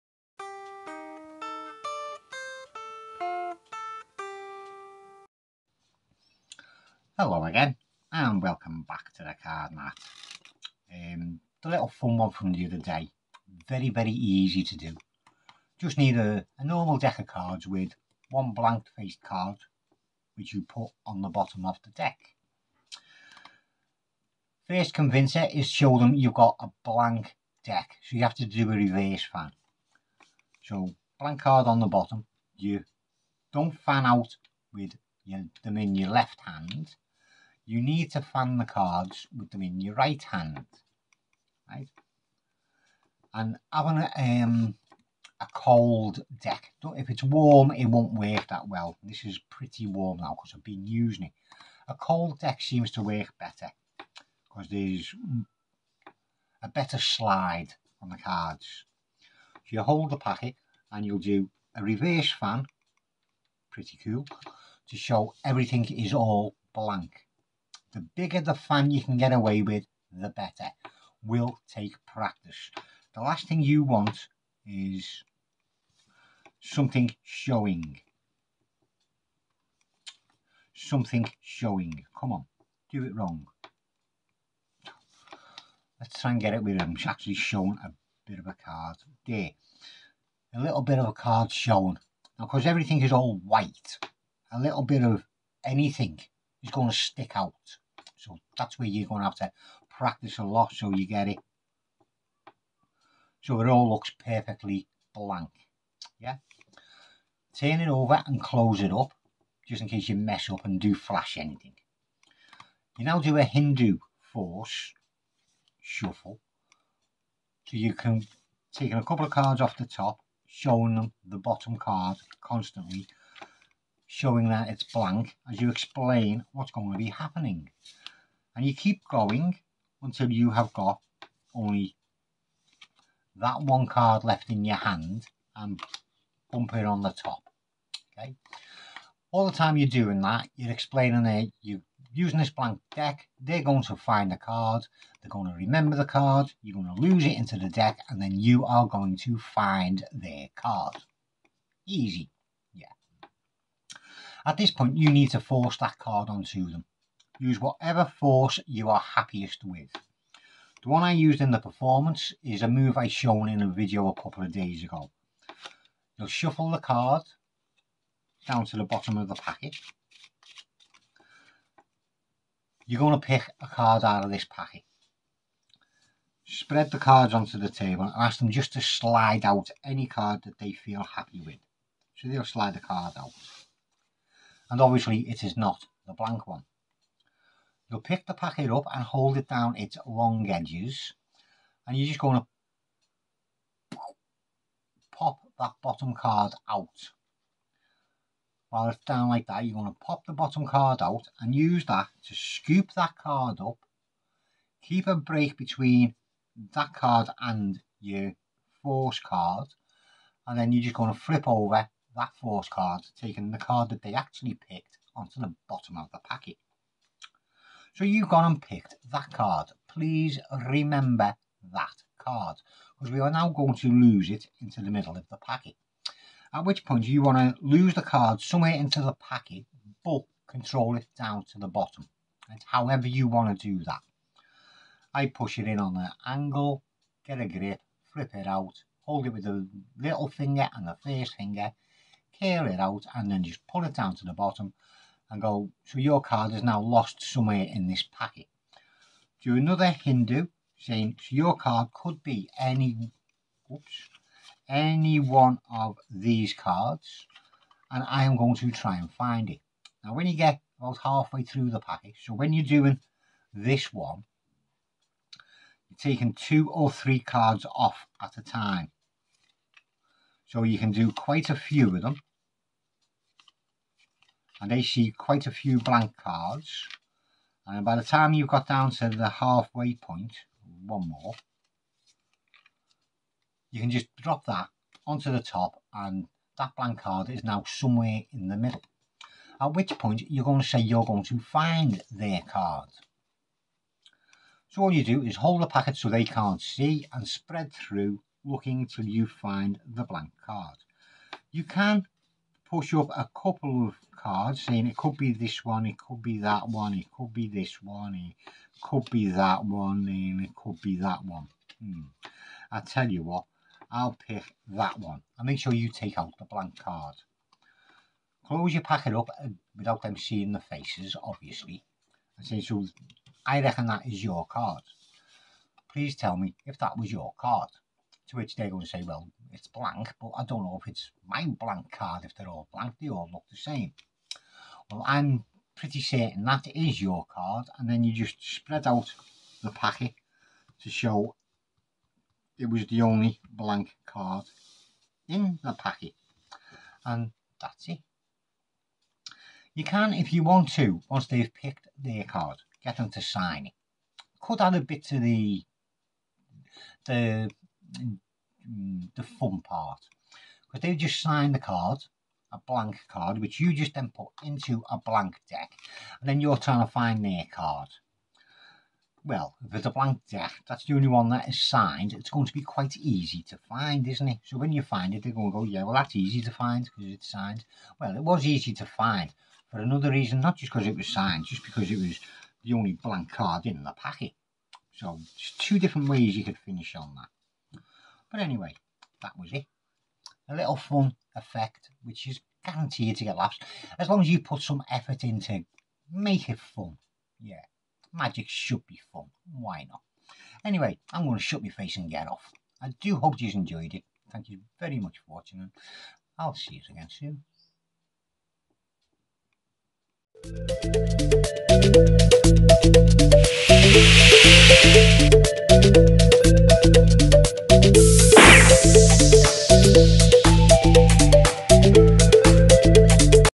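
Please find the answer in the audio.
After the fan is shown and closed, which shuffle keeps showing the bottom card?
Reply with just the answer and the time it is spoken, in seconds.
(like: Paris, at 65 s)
Hindu force shuffle, at 113 s.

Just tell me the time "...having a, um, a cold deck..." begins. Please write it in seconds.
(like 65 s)
43 s.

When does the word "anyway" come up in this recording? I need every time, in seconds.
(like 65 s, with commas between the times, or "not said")
388 s, 400 s.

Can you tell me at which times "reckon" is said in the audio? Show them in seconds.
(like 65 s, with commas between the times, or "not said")
323 s.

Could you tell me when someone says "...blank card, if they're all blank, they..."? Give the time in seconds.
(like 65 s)
331 s.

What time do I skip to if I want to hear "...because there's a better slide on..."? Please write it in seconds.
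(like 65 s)
54 s.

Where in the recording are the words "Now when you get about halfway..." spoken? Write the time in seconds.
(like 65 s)
260 s.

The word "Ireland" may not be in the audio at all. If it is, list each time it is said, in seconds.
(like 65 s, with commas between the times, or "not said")
not said.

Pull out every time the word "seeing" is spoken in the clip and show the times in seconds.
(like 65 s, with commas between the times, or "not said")
320 s.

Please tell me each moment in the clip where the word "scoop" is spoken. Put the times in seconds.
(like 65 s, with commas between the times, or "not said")
202 s.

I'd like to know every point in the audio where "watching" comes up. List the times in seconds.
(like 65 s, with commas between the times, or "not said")
405 s.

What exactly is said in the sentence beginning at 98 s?
So that's where you're going to have to practice a lot so you get it.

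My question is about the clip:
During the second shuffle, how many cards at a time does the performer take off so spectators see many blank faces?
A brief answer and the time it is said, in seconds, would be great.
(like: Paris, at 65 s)
2 or 3, at 266 s.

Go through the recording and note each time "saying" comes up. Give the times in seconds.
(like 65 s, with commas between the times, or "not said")
250 s, 304 s.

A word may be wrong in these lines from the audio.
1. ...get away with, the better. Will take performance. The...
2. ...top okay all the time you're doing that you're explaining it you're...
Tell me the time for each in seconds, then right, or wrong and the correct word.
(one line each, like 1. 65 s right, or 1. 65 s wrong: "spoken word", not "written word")
1. 69 s wrong: "practice", not "performance"
2. 137 s right.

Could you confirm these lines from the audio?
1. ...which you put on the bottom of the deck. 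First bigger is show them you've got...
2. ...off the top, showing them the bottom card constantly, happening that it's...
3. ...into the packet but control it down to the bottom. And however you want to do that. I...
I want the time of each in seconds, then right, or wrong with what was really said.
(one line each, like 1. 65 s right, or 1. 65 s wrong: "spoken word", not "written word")
1. 20 s wrong: "convincer", not "bigger"
2. 119 s wrong: "showing", not "happening"
3. 228 s right.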